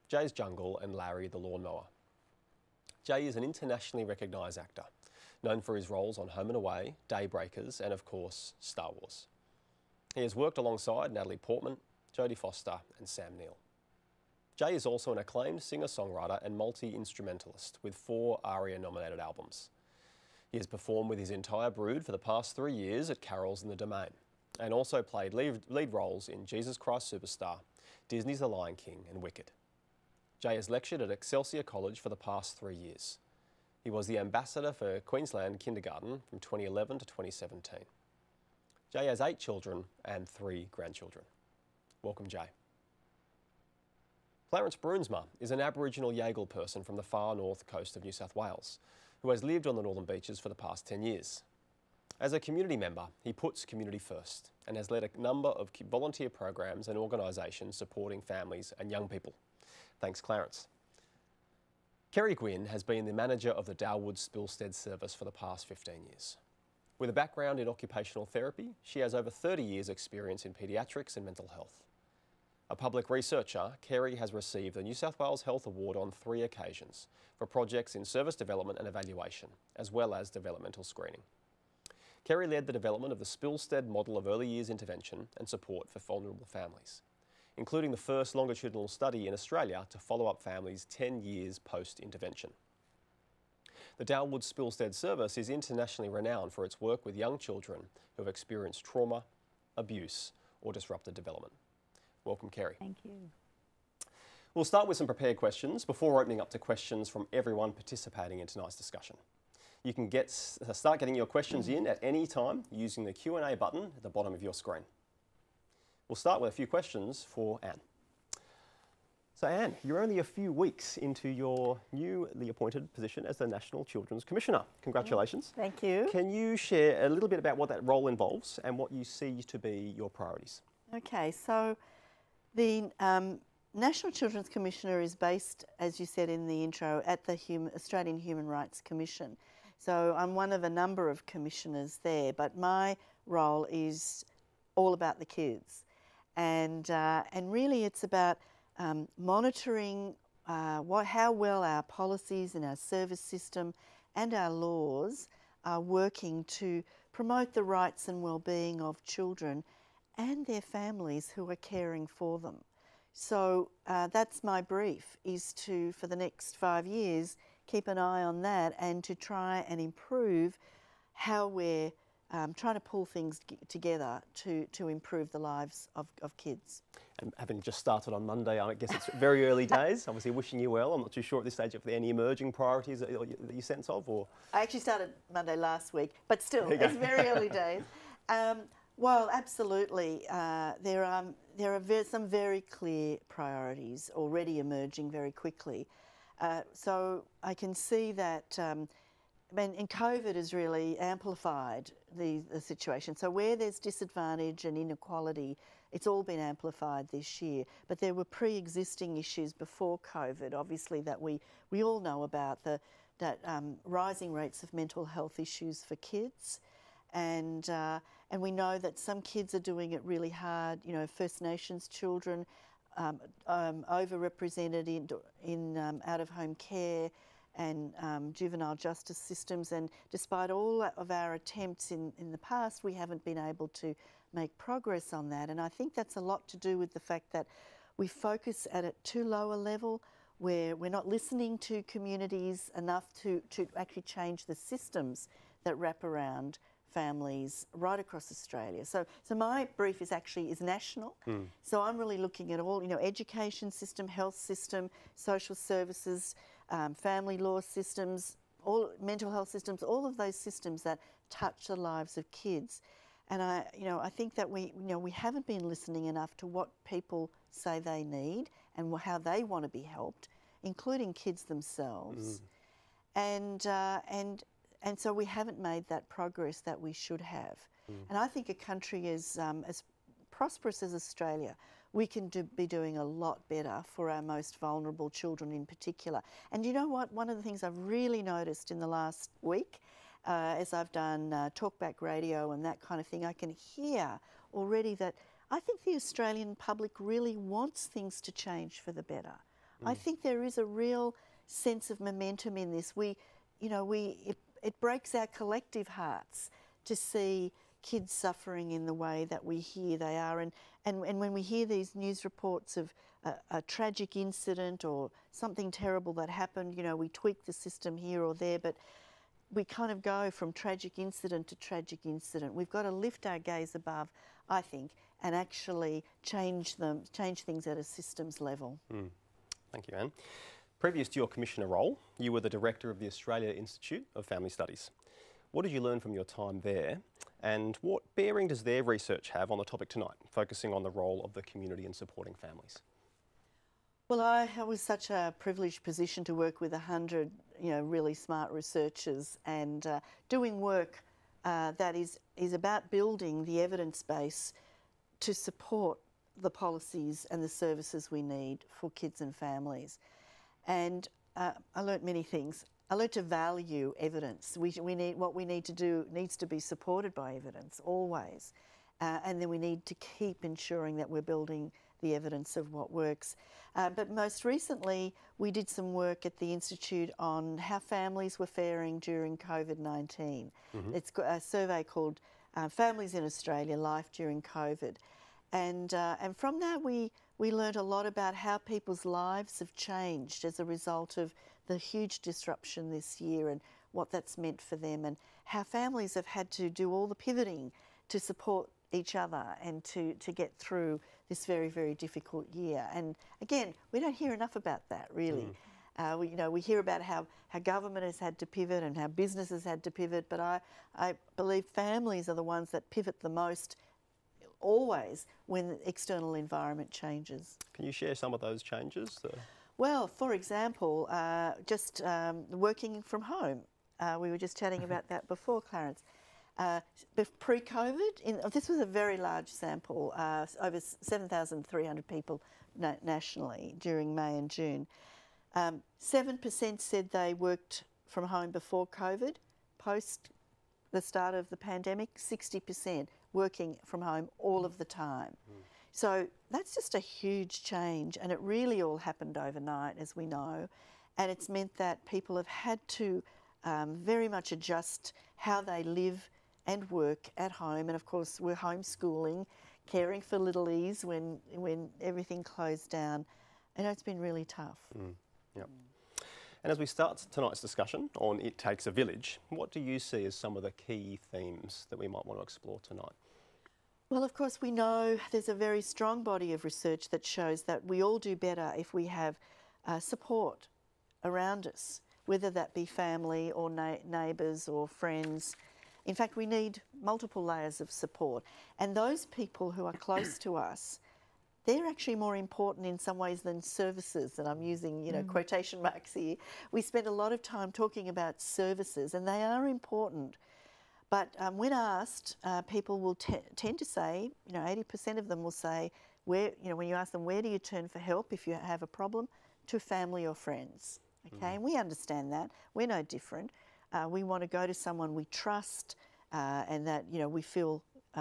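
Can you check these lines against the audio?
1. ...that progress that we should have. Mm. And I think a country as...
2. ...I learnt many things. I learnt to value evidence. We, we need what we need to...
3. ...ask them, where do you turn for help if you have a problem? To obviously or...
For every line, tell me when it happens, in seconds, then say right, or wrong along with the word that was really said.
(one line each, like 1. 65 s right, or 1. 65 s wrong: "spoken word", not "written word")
1. 275 s right
2. 361 s right
3. 506 s wrong: "family", not "obviously".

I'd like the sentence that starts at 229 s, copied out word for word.
And despite all of our attempts in, in the past, we haven't been able to make progress on that.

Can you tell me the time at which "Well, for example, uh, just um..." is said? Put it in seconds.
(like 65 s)
419 s.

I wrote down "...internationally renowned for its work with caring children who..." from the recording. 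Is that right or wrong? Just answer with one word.
wrong.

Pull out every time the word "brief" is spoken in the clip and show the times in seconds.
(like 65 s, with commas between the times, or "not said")
164 s, 249 s.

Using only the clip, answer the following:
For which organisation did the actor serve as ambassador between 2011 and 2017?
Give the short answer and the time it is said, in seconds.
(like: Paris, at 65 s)
Queensland Kindergarten, at 35 s.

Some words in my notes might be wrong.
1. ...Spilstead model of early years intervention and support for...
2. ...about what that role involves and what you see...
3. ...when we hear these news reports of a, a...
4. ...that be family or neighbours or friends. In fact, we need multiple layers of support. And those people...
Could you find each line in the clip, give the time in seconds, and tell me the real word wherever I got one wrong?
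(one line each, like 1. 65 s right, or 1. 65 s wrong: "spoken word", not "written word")
1. 83 s right
2. 127 s right
3. 311 s right
4. 482 s right.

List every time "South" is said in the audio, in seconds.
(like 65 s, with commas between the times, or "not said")
48 s, 74 s.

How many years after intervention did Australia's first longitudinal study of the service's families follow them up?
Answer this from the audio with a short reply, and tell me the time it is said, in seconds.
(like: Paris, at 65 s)
10, at 90 s.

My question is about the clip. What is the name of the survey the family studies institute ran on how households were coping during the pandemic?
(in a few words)
Families in Australia Life During COVID.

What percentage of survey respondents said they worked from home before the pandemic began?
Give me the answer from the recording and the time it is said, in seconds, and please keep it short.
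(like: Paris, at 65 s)
7%, at 435 s.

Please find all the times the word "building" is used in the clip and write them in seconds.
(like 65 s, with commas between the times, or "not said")
352 s, 371 s.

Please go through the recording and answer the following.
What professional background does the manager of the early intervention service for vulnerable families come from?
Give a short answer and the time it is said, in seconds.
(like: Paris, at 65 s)
occupational therapy, at 67 s.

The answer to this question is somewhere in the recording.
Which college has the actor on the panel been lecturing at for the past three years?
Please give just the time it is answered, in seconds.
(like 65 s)
31 s.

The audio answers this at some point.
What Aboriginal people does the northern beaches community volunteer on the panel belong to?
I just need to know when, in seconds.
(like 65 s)
46 s.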